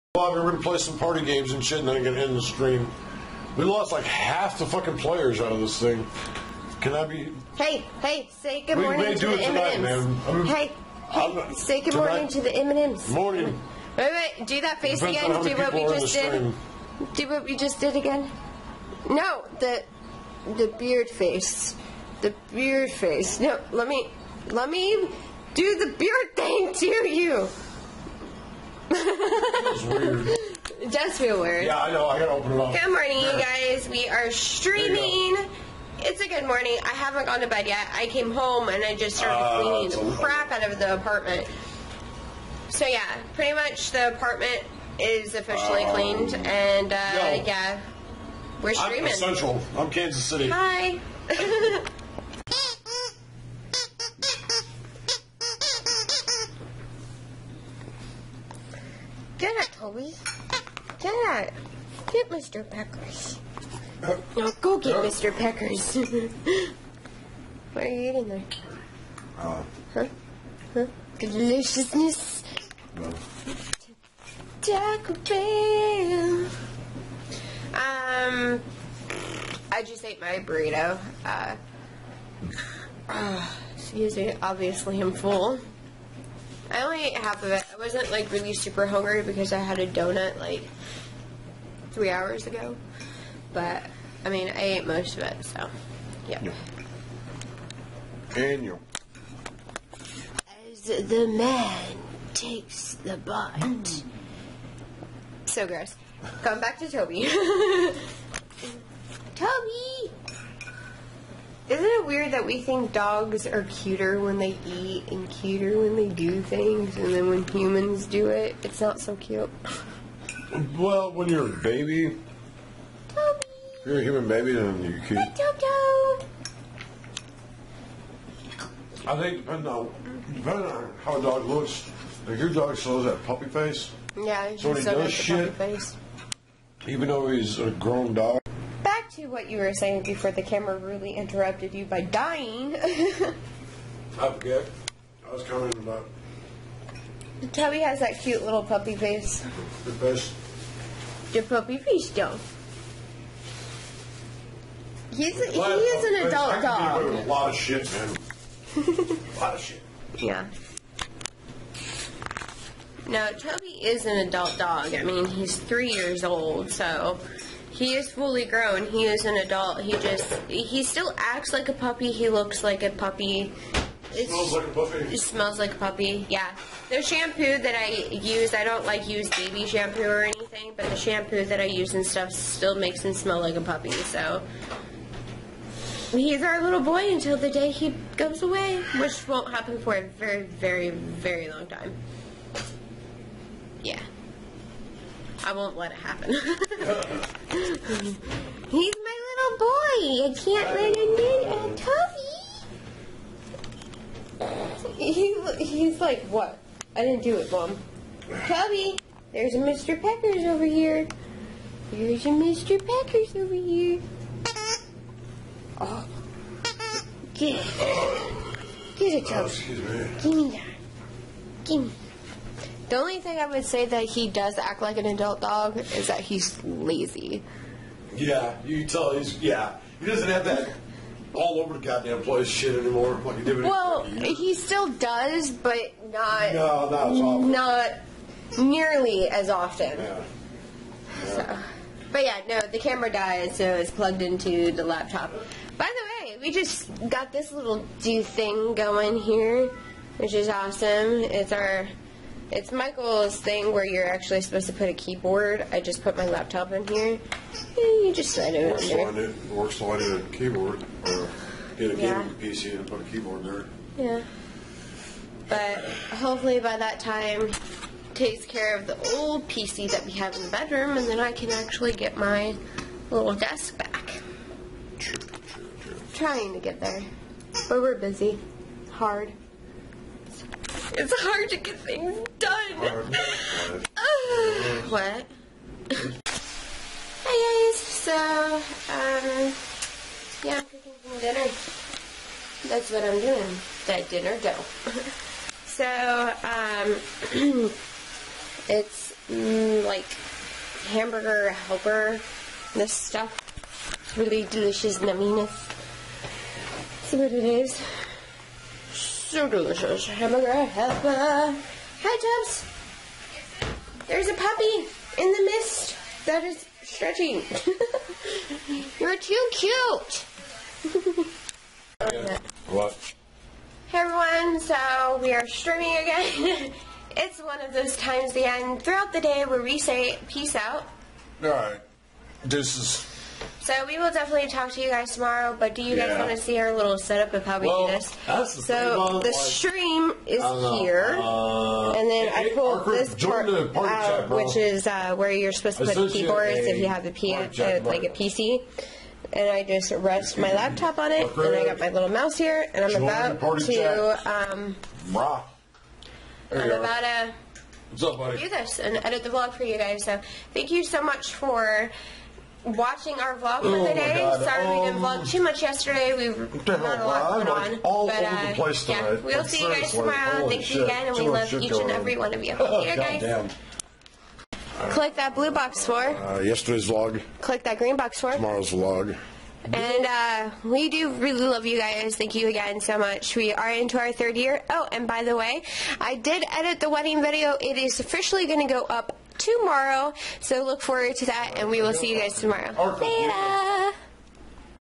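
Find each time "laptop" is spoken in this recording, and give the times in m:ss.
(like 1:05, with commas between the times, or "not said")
4:04, 4:16, 5:50.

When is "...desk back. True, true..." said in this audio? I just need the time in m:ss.
4:33.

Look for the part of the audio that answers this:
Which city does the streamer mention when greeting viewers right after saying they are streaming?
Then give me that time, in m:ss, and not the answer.
0:49.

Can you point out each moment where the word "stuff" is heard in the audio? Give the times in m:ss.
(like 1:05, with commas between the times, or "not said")
3:02, 5:02.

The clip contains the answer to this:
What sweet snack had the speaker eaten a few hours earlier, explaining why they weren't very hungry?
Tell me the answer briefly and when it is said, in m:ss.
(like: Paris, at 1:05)
A donut, at 1:29.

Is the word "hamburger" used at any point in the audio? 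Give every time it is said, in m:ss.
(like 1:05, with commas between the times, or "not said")
5:00, 5:10.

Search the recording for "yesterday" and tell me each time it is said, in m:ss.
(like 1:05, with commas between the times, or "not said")
6:05, 6:16.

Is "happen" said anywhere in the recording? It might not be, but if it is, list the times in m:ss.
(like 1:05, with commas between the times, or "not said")
3:09, 3:15.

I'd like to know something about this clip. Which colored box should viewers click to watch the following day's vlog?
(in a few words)
Green.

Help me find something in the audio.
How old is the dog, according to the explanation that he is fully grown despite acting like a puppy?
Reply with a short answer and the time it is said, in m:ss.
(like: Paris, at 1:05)
3, at 2:45.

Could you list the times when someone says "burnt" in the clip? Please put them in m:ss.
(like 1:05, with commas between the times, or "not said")
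not said.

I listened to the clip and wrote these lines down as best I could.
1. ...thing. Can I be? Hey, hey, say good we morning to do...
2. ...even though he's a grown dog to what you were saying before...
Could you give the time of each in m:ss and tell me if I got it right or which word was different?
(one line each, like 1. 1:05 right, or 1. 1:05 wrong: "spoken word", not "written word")
1. 0:05 right
2. 2:16 right.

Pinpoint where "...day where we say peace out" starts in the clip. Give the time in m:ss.
5:29.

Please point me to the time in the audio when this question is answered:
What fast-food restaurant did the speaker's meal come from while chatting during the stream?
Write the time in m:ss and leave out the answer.
1:14.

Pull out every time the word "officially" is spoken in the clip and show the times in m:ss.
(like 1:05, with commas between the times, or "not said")
0:45, 6:27.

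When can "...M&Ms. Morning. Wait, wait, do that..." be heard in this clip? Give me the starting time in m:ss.
0:12.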